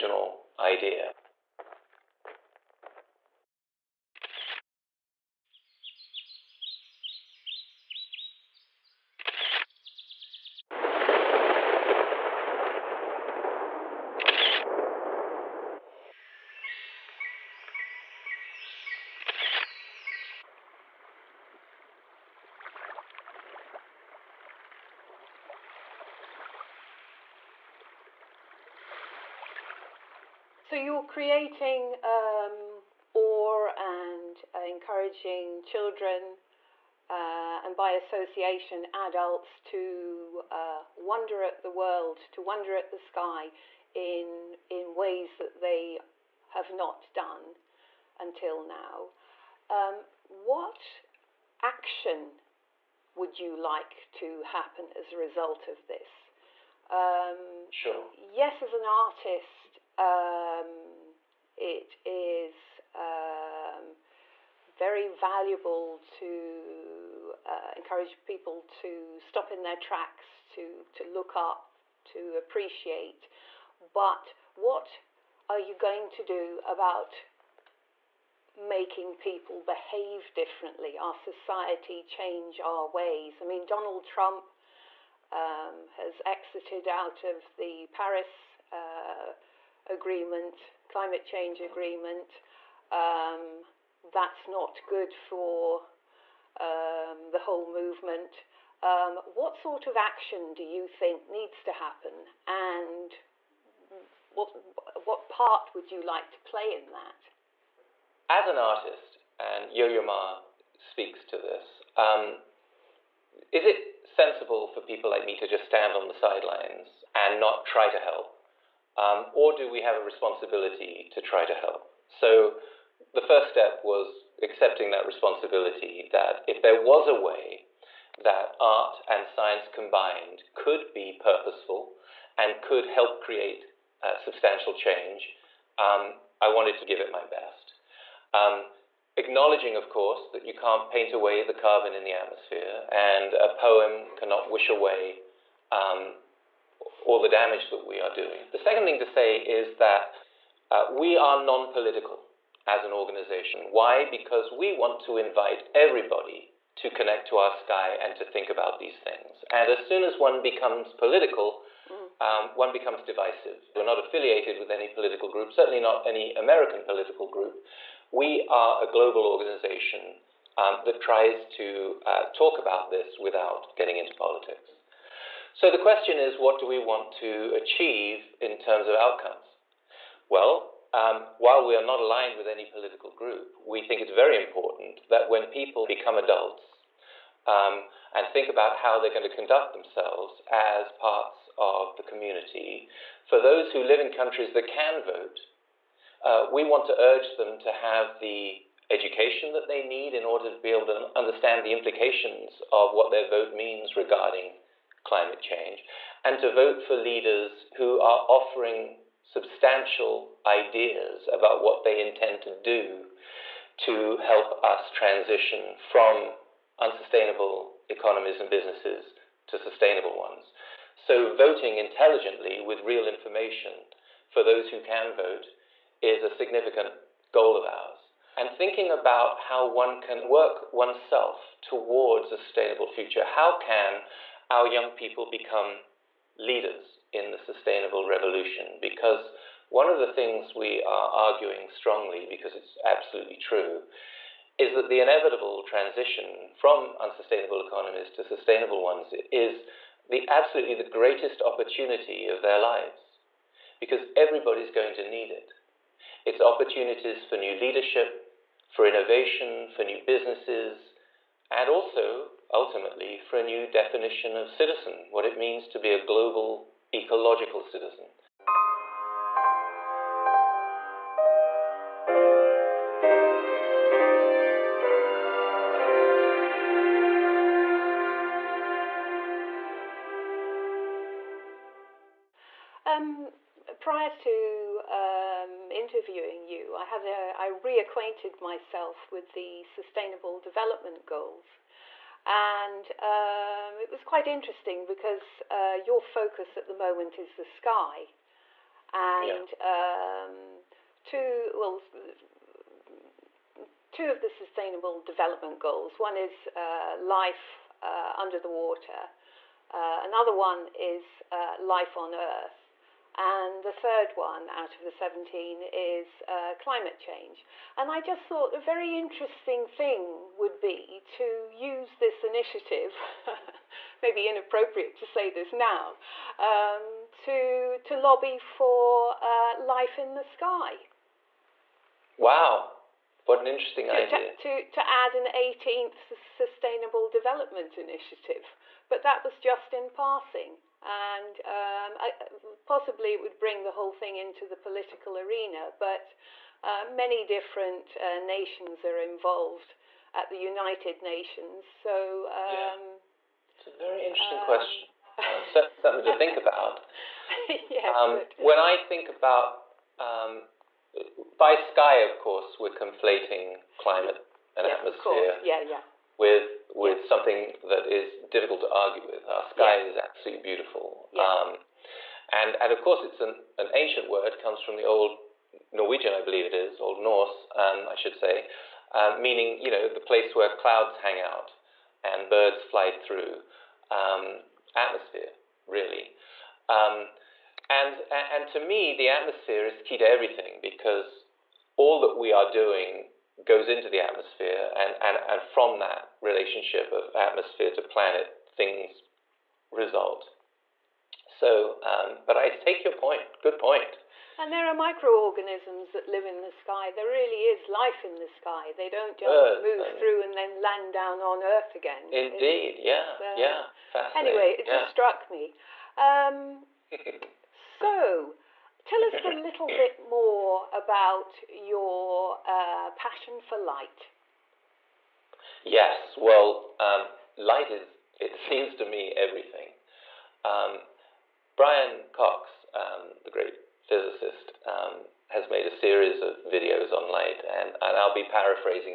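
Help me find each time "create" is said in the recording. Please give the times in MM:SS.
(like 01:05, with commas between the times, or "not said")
02:13.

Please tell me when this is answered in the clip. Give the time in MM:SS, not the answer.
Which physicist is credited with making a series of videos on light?
07:11.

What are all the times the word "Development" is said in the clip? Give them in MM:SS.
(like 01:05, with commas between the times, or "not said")
04:50, 05:04, 05:37.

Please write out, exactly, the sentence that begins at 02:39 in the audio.
And as soon as one becomes political, mm.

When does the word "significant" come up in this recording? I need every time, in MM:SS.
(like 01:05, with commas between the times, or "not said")
03:46.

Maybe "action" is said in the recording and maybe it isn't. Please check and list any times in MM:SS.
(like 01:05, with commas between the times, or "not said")
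00:51, 01:39.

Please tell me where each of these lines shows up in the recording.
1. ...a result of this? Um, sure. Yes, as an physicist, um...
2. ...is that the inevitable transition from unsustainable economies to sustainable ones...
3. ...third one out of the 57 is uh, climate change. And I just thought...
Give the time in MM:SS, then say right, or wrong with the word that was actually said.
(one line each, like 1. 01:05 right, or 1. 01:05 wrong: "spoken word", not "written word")
1. 00:55 wrong: "artist", not "physicist"
2. 04:04 right
3. 05:13 wrong: "17", not "57".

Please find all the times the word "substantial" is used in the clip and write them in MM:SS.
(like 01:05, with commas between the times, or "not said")
02:14, 03:29.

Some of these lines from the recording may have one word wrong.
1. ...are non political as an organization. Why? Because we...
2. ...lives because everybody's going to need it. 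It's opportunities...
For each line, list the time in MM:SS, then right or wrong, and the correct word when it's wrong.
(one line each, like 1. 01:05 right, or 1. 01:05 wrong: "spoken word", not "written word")
1. 02:31 right
2. 04:12 right.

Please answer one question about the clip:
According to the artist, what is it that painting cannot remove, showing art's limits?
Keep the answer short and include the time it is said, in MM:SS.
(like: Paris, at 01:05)
the carbon in the atmosphere, at 02:21.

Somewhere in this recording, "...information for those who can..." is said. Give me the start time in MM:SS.
03:43.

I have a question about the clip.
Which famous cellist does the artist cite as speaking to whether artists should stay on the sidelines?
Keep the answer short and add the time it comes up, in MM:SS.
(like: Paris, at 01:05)
Yo-Yo Ma, at 01:49.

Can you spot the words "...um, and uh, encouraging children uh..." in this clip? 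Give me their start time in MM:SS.
00:33.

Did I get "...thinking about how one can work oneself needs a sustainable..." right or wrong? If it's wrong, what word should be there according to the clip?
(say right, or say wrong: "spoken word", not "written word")
wrong: "towards", not "needs".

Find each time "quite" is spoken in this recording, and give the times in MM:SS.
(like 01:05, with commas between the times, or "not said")
04:54.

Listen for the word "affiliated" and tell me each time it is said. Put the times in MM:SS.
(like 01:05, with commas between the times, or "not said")
02:44.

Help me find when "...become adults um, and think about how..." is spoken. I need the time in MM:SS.
03:05.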